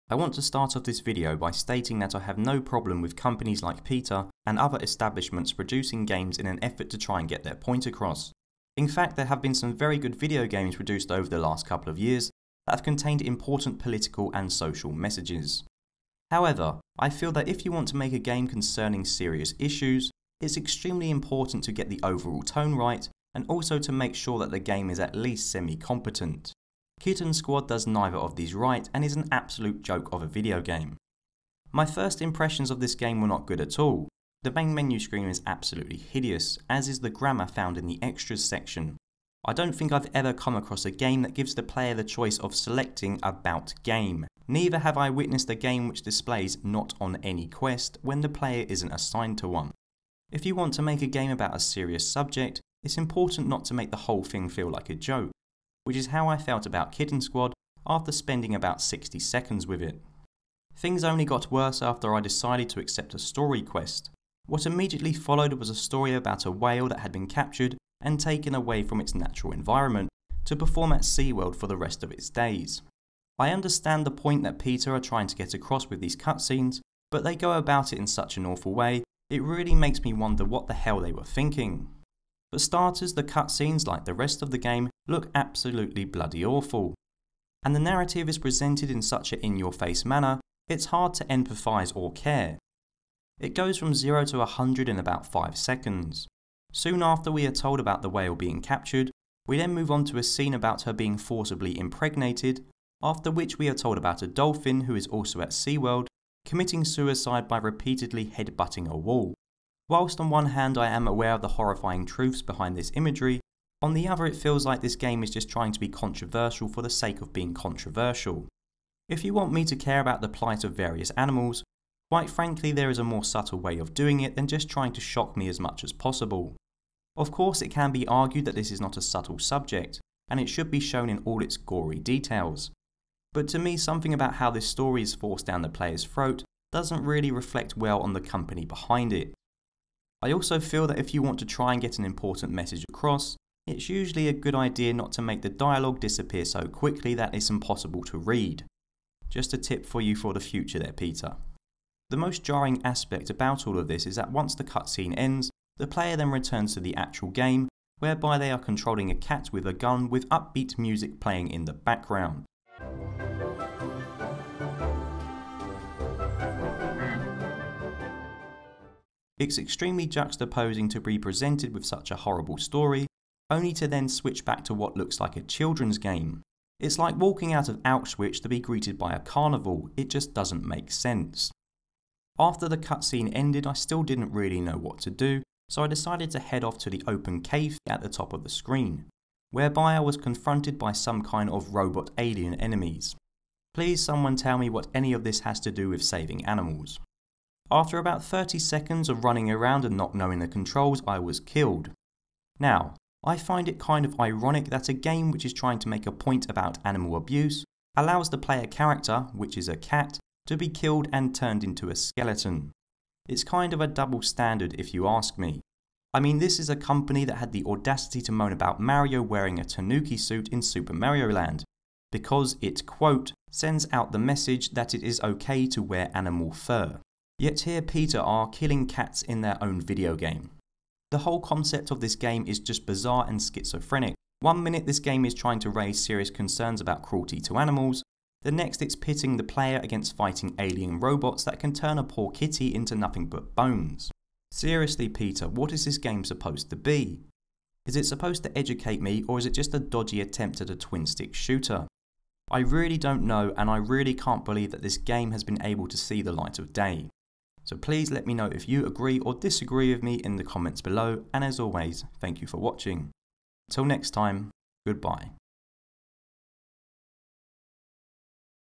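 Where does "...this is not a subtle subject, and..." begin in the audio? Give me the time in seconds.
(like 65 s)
128 s.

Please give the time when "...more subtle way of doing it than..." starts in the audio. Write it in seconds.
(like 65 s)
123 s.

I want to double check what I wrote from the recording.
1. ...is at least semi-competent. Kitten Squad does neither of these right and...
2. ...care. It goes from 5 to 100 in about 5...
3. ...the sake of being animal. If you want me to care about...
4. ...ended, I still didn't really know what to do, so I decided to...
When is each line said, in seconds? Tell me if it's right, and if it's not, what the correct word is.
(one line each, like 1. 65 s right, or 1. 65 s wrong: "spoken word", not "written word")
1. 24 s right
2. 92 s wrong: "0", not "5"
3. 116 s wrong: "controversial", not "animal"
4. 183 s right.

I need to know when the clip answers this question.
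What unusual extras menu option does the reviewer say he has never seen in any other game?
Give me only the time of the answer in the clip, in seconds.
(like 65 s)
43 s.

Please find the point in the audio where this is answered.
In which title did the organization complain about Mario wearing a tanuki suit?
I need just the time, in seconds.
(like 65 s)
220 s.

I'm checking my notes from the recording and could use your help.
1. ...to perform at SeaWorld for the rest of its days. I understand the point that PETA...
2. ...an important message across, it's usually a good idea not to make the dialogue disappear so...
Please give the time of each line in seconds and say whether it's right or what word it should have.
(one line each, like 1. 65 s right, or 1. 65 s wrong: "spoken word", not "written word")
1. 70 s right
2. 141 s right.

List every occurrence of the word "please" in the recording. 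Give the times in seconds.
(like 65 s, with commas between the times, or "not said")
193 s, 257 s.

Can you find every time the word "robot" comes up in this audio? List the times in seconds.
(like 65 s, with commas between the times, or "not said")
191 s, 240 s.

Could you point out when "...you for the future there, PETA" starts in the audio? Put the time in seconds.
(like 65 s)
149 s.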